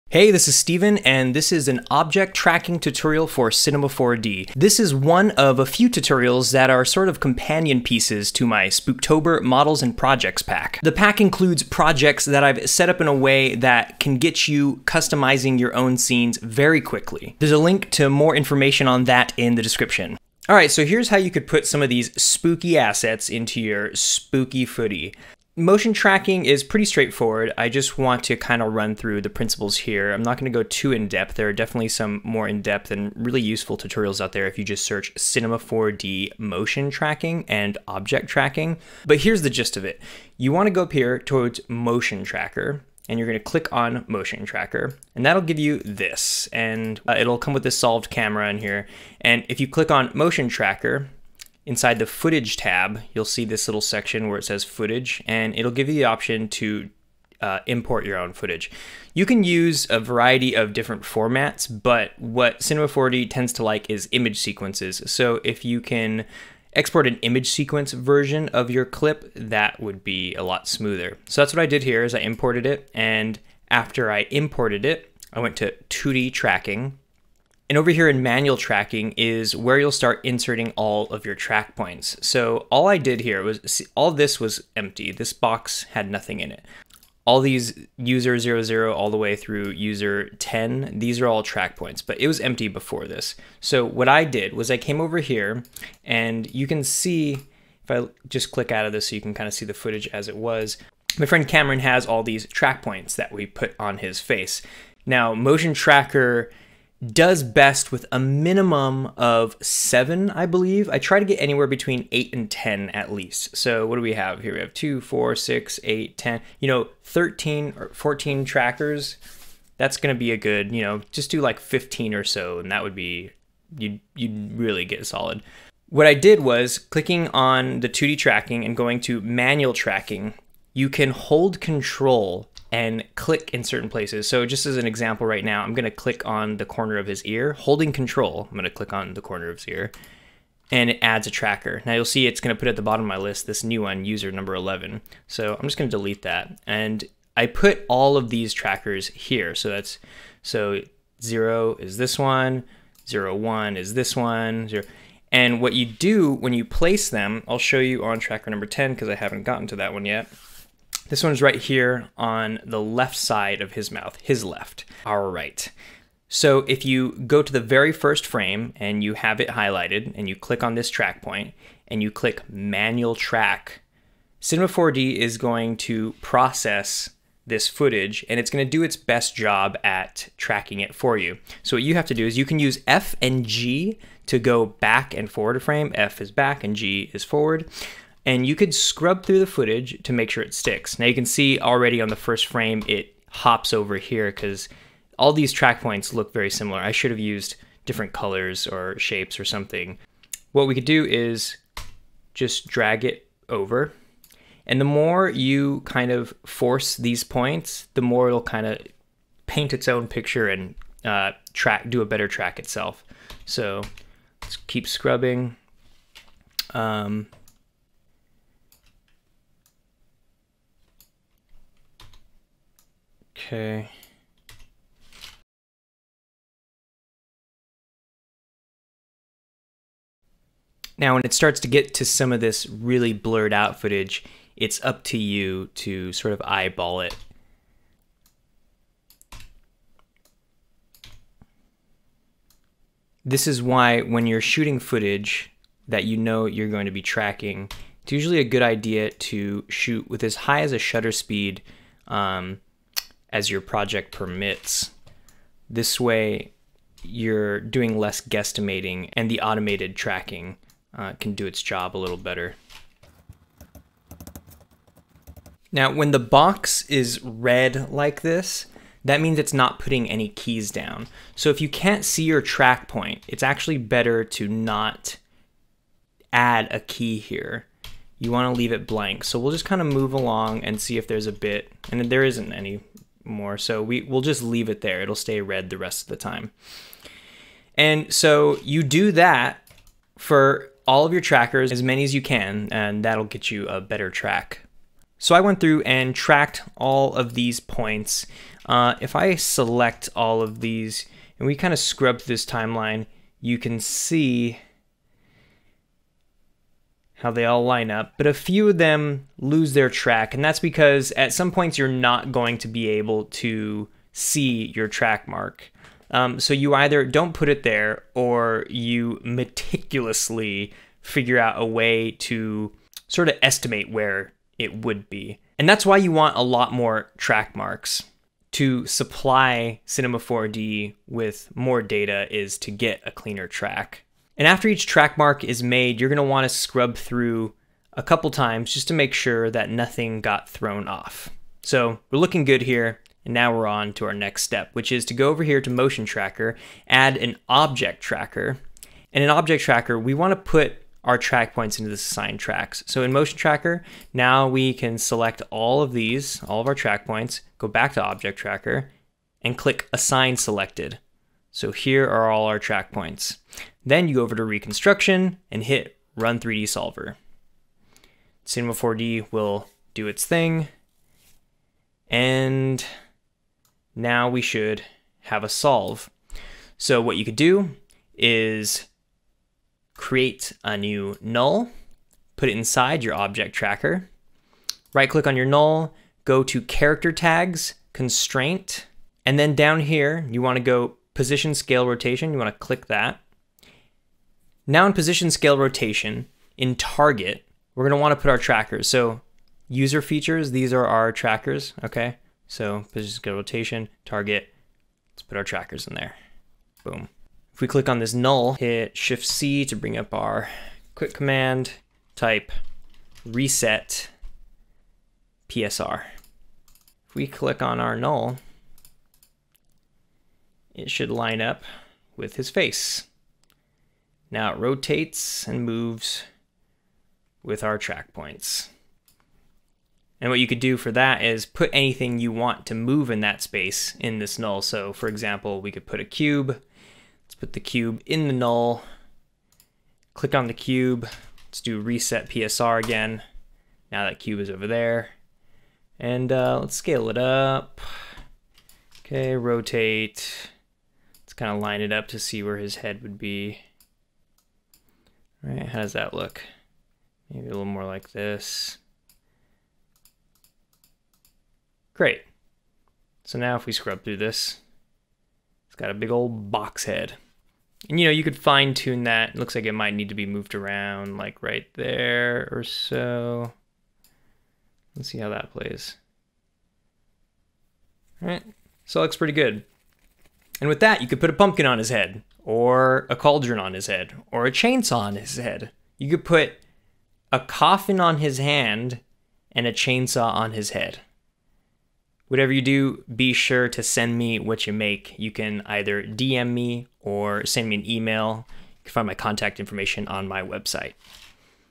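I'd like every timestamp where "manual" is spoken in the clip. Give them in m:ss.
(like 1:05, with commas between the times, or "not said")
1:18, 2:09, 2:52.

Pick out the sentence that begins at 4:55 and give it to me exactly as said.
So I went through and tracked all of these points.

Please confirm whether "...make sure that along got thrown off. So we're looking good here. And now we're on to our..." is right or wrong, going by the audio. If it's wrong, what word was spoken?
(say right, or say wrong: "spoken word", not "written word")
wrong: "nothing", not "along".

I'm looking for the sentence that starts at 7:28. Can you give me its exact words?
Okay, rotate kind of line it up to see where his head would be.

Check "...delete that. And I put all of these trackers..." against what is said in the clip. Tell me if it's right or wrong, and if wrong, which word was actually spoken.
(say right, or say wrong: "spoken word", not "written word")
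right.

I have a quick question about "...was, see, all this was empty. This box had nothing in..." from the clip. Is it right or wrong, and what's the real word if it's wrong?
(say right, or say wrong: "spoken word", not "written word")
right.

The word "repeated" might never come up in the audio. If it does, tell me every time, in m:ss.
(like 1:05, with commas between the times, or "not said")
not said.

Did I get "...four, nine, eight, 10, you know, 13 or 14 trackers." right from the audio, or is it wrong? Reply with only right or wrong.
wrong.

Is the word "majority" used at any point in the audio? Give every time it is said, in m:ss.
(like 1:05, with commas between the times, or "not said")
not said.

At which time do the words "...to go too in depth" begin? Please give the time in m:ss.
0:30.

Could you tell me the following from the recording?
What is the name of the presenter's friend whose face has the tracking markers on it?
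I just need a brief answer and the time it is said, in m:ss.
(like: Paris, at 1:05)
Cameron, at 1:41.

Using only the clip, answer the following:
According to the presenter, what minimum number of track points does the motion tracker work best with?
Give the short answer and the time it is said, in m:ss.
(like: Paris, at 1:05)
7, at 1:49.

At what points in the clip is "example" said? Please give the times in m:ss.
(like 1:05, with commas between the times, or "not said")
2:14, 7:15.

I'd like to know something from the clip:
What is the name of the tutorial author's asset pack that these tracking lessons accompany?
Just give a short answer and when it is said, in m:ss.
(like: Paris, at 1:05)
Spooktober Models and Projects, at 0:08.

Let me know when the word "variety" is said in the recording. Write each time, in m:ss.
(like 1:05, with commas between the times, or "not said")
0:59.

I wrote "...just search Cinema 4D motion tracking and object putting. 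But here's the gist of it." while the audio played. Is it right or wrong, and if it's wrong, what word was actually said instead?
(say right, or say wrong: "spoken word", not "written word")
wrong: "tracking", not "putting".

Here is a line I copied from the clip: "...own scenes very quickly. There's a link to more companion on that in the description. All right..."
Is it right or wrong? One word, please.
wrong.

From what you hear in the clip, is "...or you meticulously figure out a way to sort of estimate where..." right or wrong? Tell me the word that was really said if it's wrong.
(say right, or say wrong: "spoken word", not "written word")
right.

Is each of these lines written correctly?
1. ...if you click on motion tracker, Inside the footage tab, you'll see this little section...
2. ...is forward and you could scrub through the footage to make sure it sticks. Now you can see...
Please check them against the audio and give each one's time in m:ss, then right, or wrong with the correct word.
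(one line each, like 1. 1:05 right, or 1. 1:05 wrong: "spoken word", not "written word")
1. 0:49 right
2. 3:07 right.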